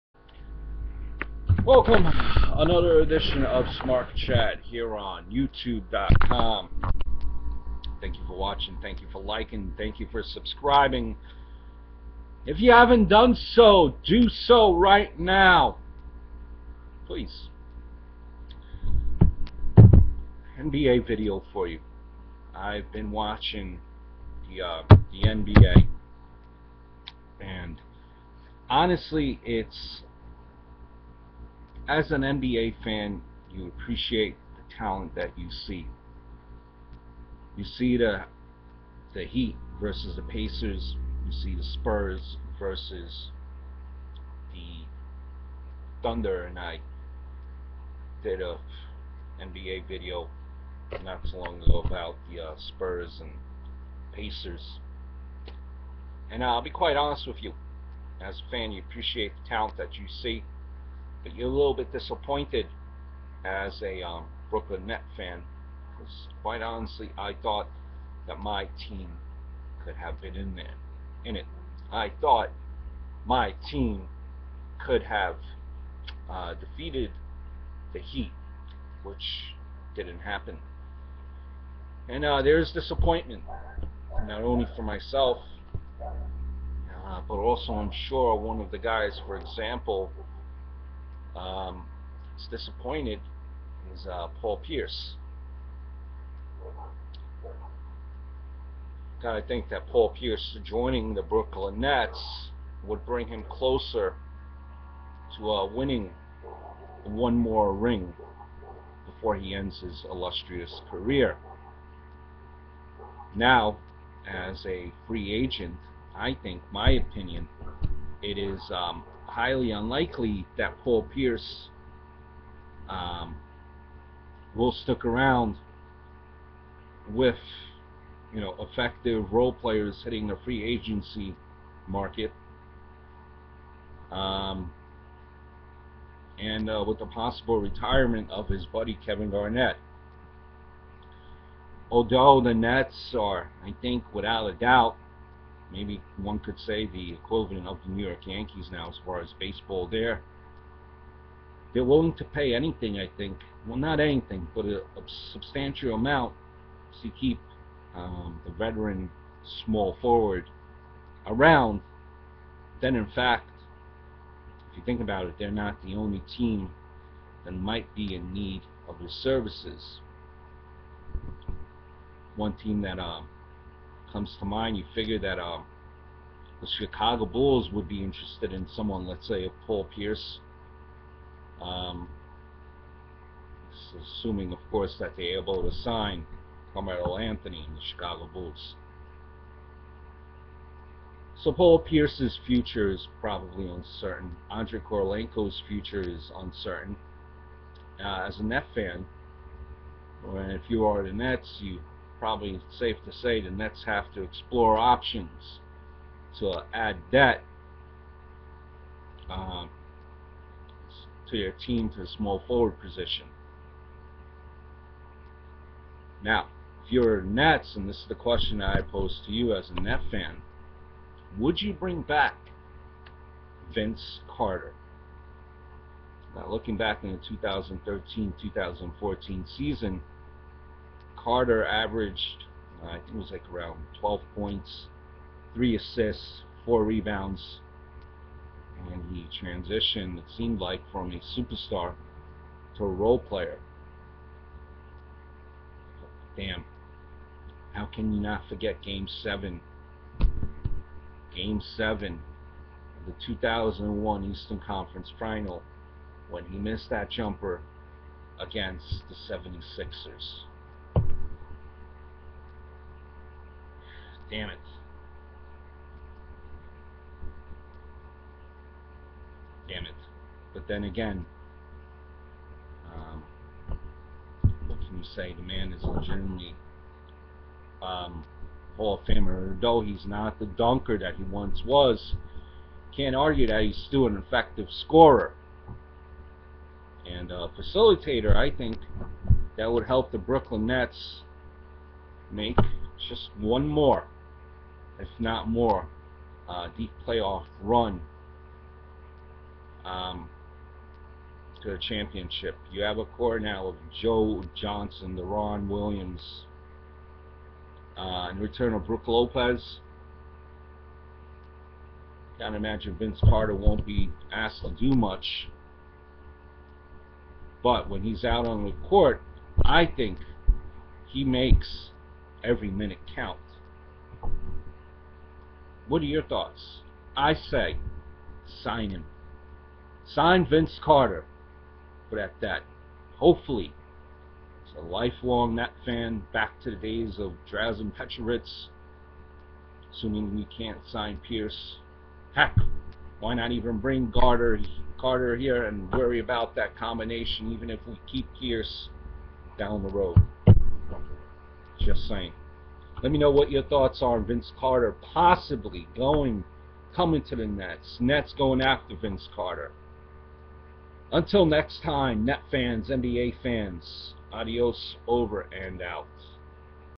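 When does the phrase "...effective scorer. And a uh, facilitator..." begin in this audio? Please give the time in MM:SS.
04:44.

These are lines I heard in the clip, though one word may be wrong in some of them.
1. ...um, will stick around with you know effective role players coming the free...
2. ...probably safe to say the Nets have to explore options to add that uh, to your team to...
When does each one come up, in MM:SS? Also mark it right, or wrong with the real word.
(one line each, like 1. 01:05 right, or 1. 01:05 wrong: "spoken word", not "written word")
1. 02:02 wrong: "hitting", not "coming"
2. 03:22 right.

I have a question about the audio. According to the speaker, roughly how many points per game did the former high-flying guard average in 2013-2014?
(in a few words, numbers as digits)
12.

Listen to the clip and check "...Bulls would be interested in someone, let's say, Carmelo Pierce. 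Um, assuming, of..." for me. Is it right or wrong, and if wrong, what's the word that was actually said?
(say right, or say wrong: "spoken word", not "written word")
wrong: "Paul", not "Carmelo".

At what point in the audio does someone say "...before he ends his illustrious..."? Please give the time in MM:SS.
01:49.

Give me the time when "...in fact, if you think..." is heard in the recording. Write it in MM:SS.
02:42.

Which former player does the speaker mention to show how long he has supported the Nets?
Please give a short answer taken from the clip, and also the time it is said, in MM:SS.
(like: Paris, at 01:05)
Drazen Petrovic, at 05:37.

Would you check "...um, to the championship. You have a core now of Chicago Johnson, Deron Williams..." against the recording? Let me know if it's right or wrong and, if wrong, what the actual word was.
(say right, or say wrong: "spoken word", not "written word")
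wrong: "Joe", not "Chicago".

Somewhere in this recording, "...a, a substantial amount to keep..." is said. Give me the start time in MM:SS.
02:34.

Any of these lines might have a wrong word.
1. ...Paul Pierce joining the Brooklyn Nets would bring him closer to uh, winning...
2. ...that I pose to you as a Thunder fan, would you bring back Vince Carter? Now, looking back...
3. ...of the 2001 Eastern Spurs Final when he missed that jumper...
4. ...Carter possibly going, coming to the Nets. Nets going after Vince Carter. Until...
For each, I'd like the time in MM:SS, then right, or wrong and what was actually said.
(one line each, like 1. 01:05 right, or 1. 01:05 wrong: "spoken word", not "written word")
1. 01:39 right
2. 03:38 wrong: "Net", not "Thunder"
3. 04:12 wrong: "Conference", not "Spurs"
4. 05:54 right.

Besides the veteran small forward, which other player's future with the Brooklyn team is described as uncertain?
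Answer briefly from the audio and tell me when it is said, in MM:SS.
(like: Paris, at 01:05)
Andrei Kirilenko, at 03:14.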